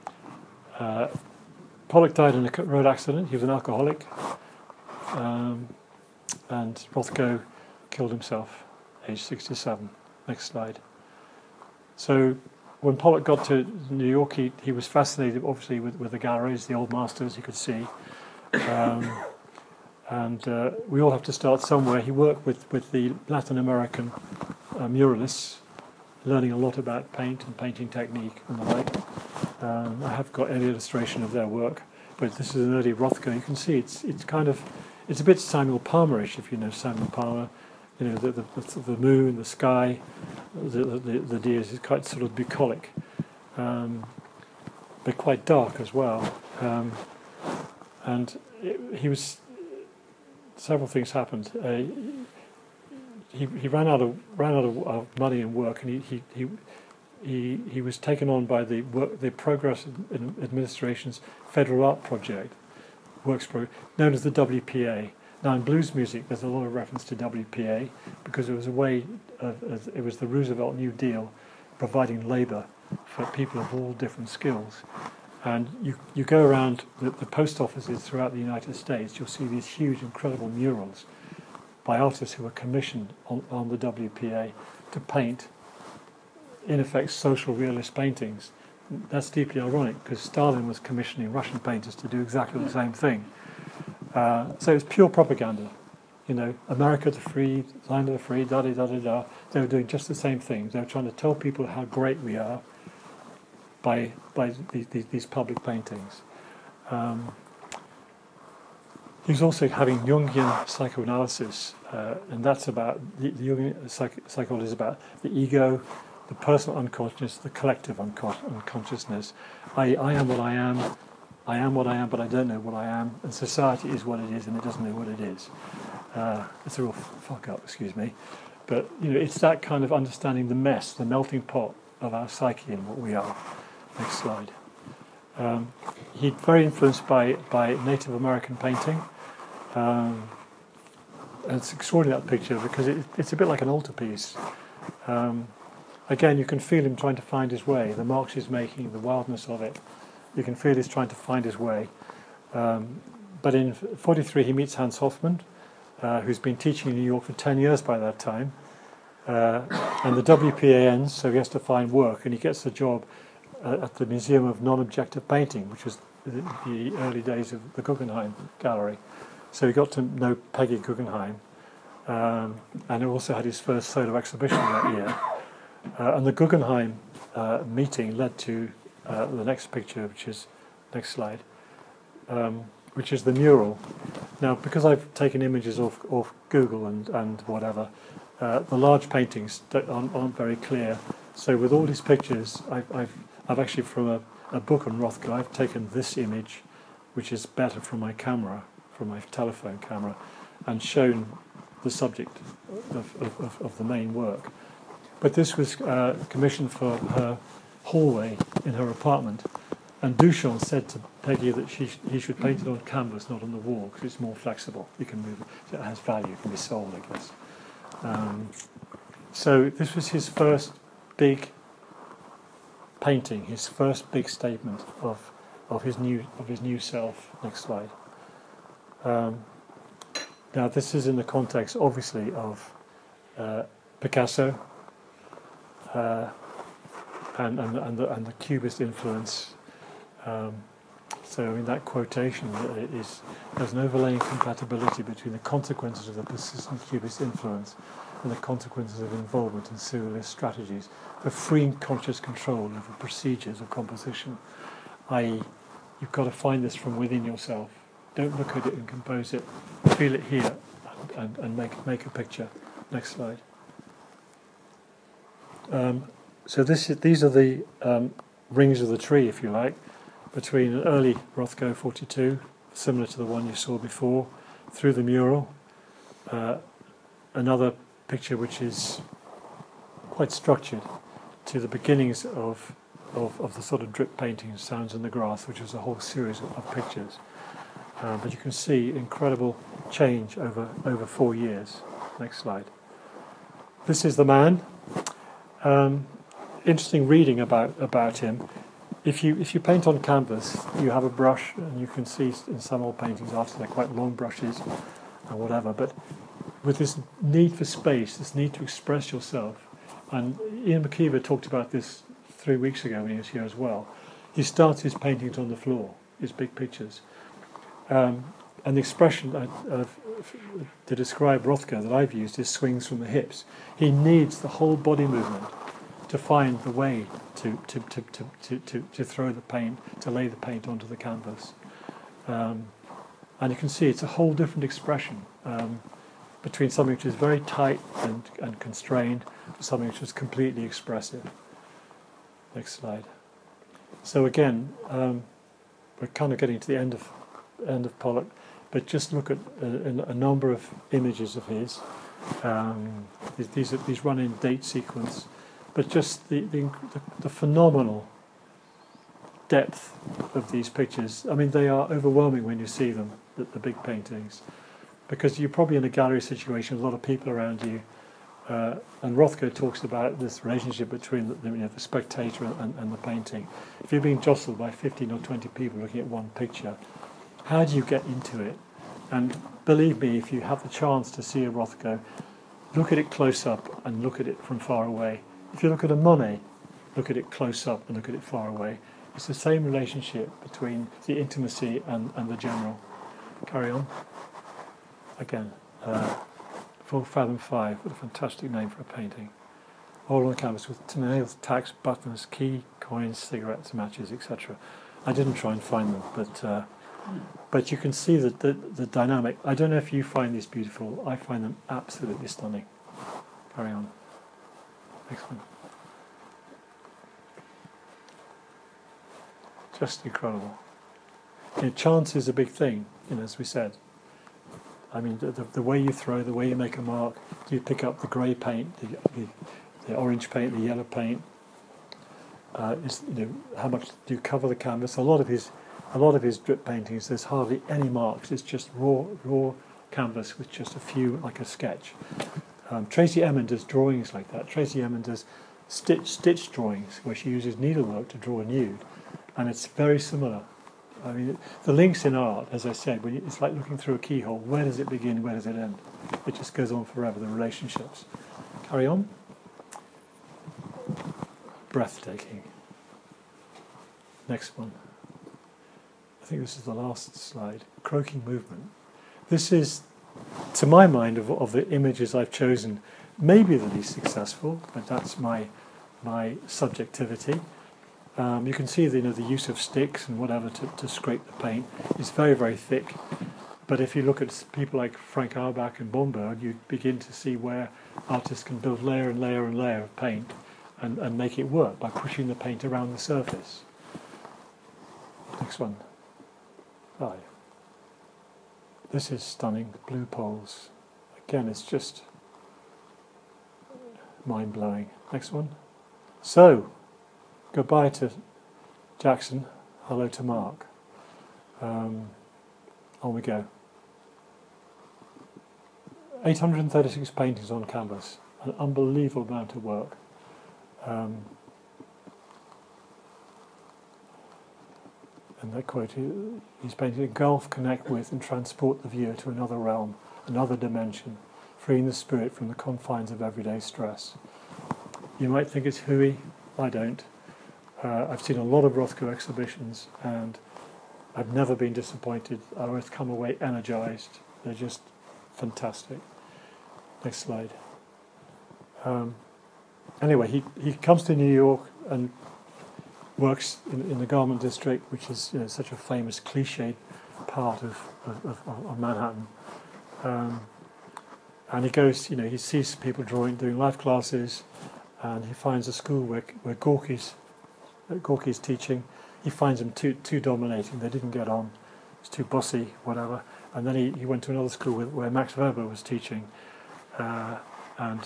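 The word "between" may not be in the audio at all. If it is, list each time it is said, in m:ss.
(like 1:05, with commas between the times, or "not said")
4:05, 4:30, 5:36, 6:10, 6:30.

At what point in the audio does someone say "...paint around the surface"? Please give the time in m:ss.
8:12.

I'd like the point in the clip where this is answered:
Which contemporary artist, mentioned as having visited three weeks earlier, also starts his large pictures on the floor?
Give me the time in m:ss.
5:10.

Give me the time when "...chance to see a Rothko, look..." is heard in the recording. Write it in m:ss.
6:20.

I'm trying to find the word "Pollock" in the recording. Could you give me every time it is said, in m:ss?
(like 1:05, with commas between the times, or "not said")
0:01, 0:12, 5:47.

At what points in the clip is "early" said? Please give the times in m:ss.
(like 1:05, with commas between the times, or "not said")
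0:32, 2:46, 4:30.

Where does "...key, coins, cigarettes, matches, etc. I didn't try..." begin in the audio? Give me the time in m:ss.
6:42.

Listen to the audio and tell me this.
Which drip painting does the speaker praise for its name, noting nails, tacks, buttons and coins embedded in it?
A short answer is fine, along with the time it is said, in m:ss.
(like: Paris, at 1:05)
Full Fathom 5, at 6:36.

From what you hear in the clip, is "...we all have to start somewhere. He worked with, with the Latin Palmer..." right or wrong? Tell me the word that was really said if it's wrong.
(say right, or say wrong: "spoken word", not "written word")
wrong: "American", not "Palmer".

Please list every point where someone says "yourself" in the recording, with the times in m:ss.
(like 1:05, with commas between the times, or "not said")
4:17, 5:09.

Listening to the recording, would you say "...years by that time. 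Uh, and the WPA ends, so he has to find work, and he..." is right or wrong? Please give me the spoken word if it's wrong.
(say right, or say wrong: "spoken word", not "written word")
right.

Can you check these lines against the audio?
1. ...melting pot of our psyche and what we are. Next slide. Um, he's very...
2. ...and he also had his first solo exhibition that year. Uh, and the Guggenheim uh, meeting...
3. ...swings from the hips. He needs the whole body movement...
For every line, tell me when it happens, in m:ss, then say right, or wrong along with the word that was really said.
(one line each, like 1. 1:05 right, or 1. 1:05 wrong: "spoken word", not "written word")
1. 2:11 right
2. 2:52 right
3. 5:22 right.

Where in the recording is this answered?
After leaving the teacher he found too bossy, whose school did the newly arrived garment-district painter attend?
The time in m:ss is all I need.
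9:35.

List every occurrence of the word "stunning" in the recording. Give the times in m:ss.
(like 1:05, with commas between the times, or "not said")
6:52, 8:19.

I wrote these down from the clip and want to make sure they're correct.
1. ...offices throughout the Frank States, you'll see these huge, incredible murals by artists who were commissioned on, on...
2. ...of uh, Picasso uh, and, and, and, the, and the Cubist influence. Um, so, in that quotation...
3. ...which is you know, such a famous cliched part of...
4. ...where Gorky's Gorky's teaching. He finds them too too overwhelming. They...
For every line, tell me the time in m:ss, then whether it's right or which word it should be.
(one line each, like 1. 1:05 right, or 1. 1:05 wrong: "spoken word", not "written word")
1. 1:17 wrong: "United", not "Frank"
2. 3:52 right
3. 9:14 right
4. 9:26 wrong: "dominating", not "overwhelming".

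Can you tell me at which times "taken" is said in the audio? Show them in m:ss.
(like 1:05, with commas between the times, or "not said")
0:57, 3:05, 3:15.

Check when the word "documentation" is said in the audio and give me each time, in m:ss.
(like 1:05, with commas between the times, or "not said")
not said.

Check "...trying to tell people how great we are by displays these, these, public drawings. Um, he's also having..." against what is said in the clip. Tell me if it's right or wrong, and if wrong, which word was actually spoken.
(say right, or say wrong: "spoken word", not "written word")
wrong: "paintings", not "drawings".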